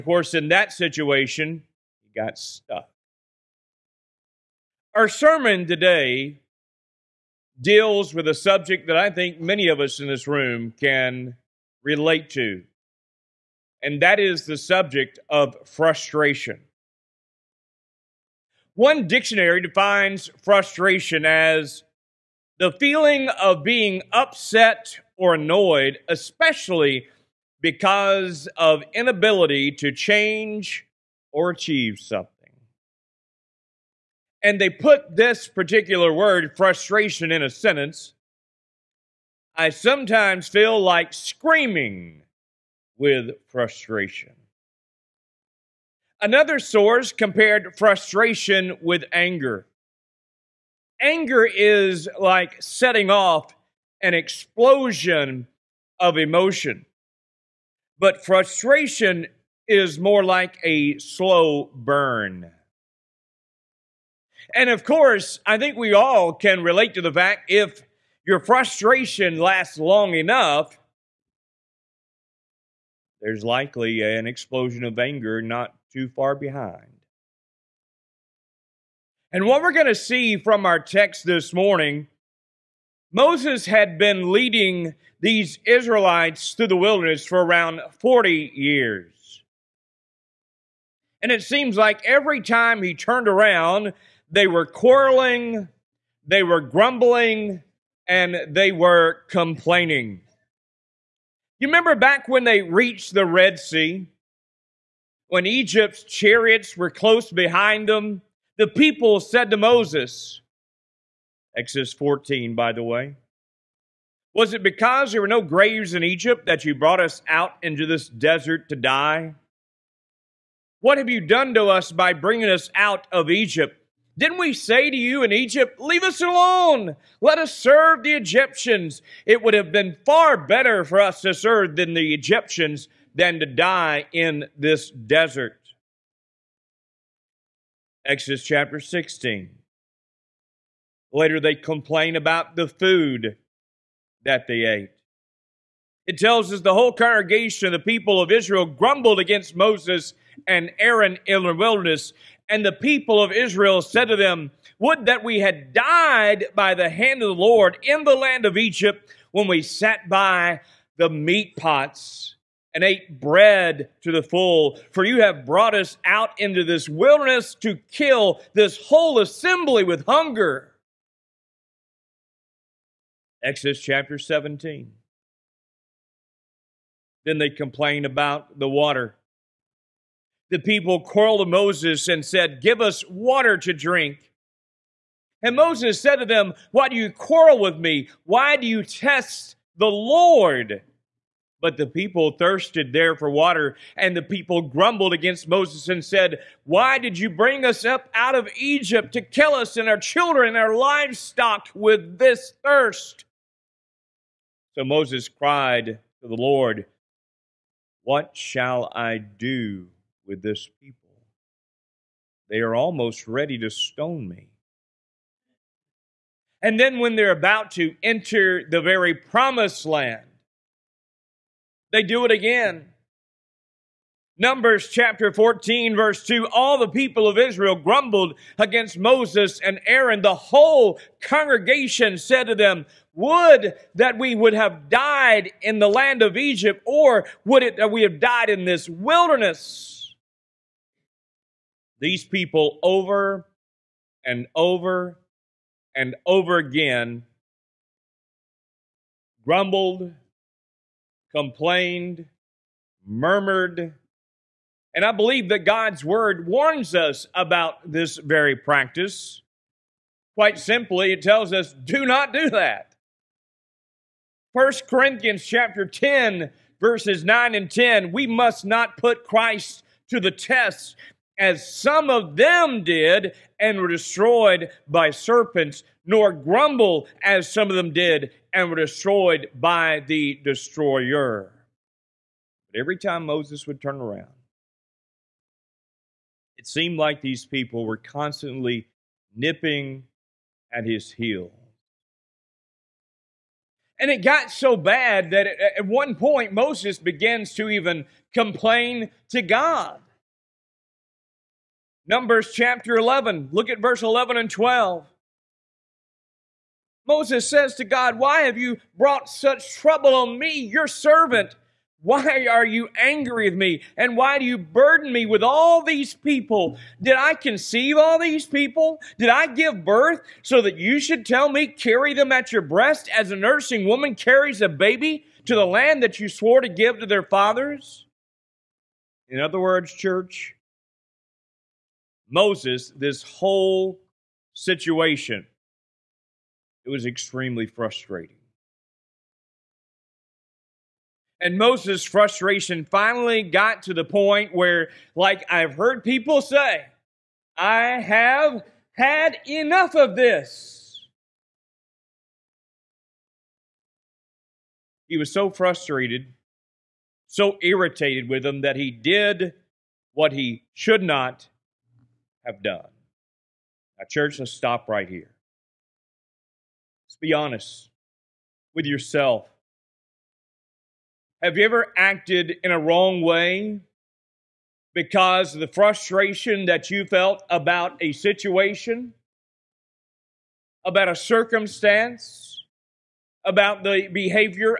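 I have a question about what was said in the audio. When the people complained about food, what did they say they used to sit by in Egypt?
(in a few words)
meat pots.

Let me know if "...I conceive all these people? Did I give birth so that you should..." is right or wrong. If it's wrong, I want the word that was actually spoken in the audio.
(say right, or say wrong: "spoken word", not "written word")
right.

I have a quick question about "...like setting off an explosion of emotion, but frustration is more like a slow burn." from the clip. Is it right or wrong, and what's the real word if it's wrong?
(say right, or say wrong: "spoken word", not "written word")
right.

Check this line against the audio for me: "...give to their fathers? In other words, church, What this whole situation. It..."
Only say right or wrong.
wrong.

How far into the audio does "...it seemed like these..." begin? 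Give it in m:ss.
4:46.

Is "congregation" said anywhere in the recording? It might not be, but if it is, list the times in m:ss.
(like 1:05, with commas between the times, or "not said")
2:26, 3:51.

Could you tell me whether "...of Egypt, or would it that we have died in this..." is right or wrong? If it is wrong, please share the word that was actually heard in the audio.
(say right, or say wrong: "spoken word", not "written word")
right.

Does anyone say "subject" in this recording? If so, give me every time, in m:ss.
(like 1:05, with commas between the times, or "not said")
0:08, 0:14.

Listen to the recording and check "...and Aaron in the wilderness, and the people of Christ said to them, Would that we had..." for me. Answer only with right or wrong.
wrong.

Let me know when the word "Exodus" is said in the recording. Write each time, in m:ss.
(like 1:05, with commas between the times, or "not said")
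1:51, 2:18, 2:53.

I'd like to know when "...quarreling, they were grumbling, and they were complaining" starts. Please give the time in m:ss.
1:34.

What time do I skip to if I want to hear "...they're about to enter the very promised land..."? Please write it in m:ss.
3:37.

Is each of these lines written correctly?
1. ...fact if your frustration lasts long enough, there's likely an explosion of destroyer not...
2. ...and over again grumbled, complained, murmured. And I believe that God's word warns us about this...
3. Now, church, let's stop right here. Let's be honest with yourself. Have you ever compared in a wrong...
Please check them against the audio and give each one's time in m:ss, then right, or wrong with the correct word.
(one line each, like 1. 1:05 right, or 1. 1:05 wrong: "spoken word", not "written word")
1. 1:07 wrong: "anger", not "destroyer"
2. 4:05 right
3. 6:03 wrong: "acted", not "compared".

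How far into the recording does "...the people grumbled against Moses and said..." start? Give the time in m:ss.
3:14.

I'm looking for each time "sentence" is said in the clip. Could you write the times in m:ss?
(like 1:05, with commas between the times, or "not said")
0:37.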